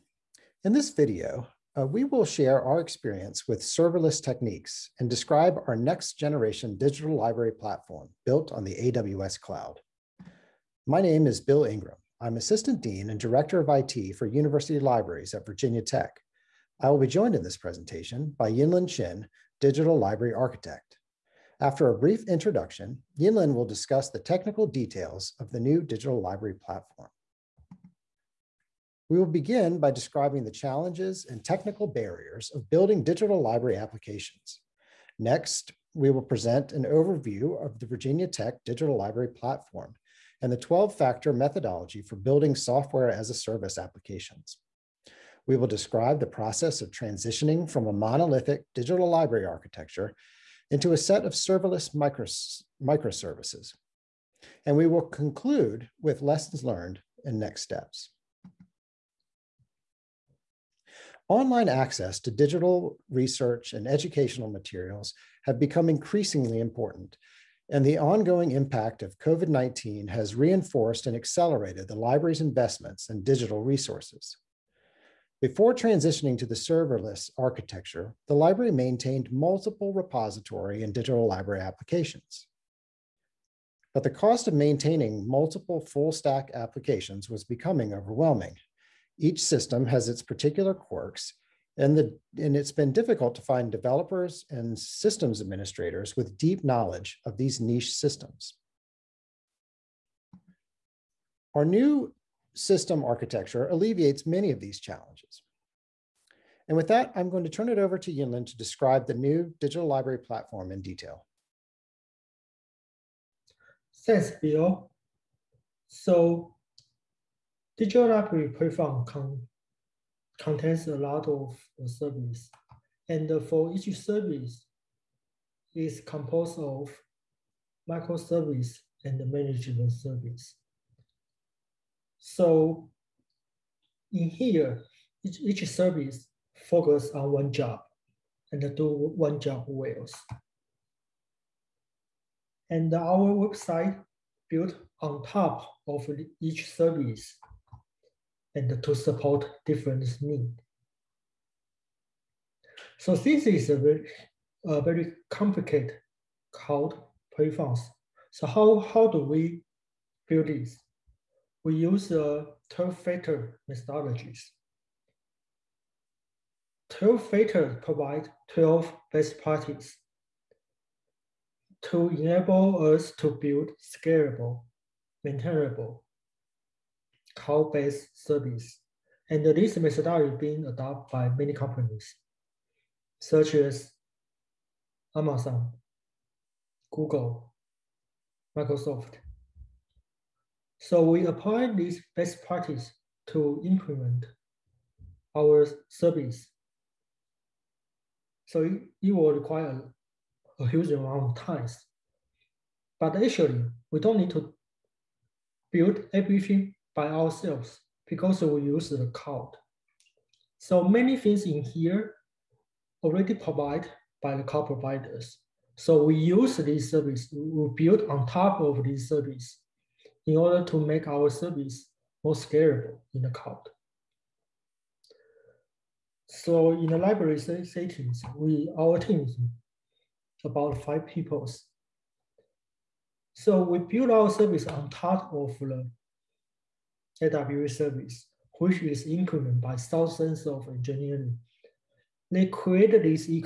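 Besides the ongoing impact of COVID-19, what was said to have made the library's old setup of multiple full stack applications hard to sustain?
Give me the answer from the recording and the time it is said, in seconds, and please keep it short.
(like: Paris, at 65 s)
the cost, at 84 s.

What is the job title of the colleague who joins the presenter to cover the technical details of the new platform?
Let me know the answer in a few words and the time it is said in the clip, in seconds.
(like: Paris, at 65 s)
Digital Library Architect, at 19 s.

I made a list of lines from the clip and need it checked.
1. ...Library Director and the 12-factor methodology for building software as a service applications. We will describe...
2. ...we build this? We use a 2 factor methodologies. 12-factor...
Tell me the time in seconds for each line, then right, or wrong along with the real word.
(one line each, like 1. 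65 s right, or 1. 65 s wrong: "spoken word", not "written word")
1. 38 s wrong: "Platform", not "Director"
2. 159 s right.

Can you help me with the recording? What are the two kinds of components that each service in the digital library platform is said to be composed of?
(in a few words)
microservice and management service.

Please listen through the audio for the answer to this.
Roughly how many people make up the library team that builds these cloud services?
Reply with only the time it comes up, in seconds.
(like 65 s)
230 s.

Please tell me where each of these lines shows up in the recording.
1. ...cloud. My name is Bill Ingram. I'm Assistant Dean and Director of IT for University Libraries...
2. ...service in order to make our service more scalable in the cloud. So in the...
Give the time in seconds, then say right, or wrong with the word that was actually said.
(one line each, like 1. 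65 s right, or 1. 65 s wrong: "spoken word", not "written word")
1. 9 s right
2. 219 s right.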